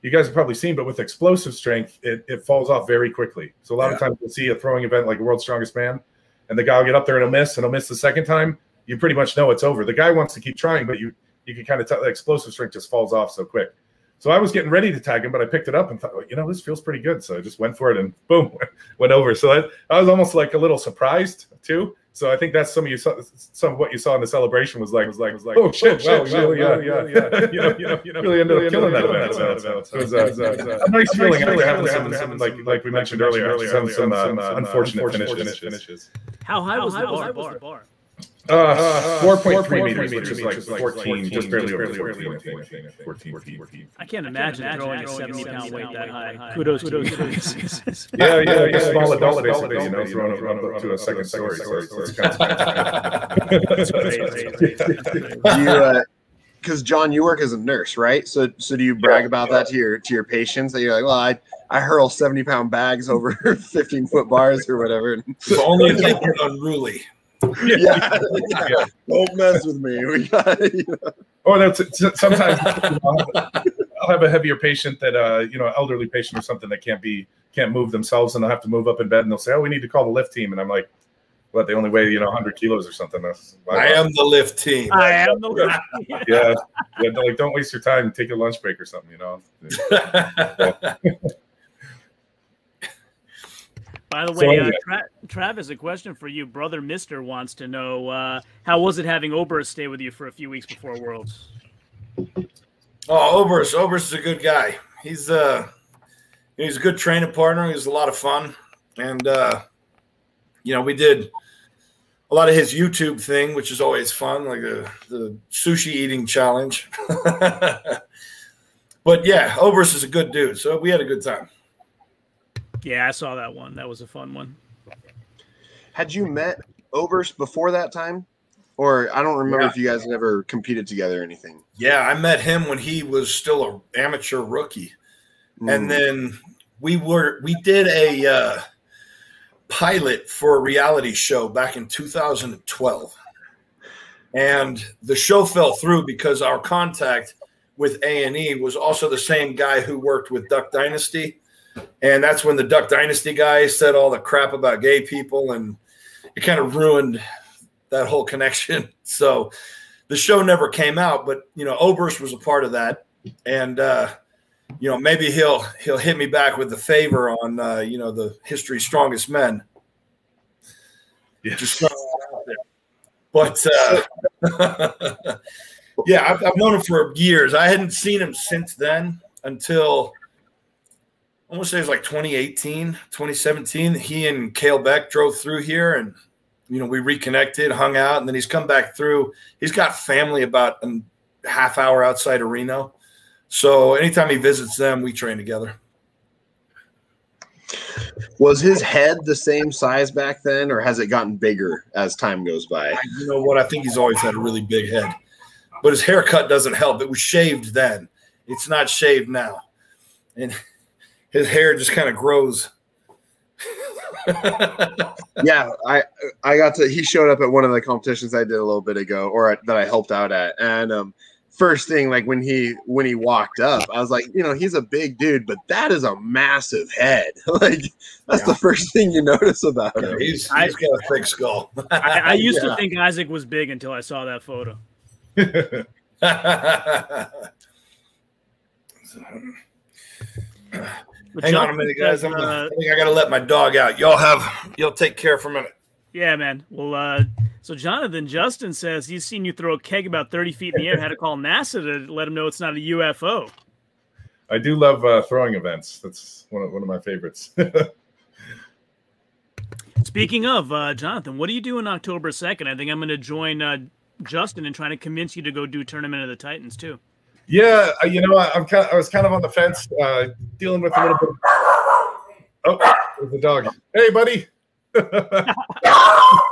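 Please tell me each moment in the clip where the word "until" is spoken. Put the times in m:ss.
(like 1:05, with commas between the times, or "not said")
2:59, 3:53.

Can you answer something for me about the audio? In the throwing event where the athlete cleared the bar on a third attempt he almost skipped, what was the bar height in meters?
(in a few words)
4.3 meters.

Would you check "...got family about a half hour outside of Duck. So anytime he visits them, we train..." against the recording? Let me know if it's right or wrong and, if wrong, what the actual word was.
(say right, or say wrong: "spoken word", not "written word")
wrong: "Reno", not "Duck".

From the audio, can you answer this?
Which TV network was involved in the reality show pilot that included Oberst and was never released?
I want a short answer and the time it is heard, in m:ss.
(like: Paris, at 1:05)
A and E, at 2:28.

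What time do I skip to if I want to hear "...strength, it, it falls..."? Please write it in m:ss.
0:01.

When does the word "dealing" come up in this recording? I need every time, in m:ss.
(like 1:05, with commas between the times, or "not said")
4:30.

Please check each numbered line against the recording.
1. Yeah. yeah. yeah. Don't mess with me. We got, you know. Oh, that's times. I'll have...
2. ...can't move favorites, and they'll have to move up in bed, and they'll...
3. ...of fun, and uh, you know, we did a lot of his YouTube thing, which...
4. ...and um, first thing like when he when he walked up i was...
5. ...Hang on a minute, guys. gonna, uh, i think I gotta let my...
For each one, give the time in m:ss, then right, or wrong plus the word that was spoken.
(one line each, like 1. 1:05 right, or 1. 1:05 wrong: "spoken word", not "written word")
1. 1:07 wrong: "sometimes", not "times"
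2. 1:17 wrong: "themselves", not "favorites"
3. 1:48 right
4. 3:40 right
5. 4:01 right.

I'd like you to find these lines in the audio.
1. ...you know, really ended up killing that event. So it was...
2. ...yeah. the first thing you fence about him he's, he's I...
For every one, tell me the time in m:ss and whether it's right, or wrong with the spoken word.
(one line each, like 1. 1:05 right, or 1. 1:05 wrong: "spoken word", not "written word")
1. 0:27 right
2. 3:48 wrong: "notice", not "fence".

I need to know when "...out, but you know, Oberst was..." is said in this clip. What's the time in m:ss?
2:40.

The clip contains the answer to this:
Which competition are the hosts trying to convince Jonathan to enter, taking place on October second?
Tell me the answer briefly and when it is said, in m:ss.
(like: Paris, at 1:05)
Tournament of the Titans, at 4:25.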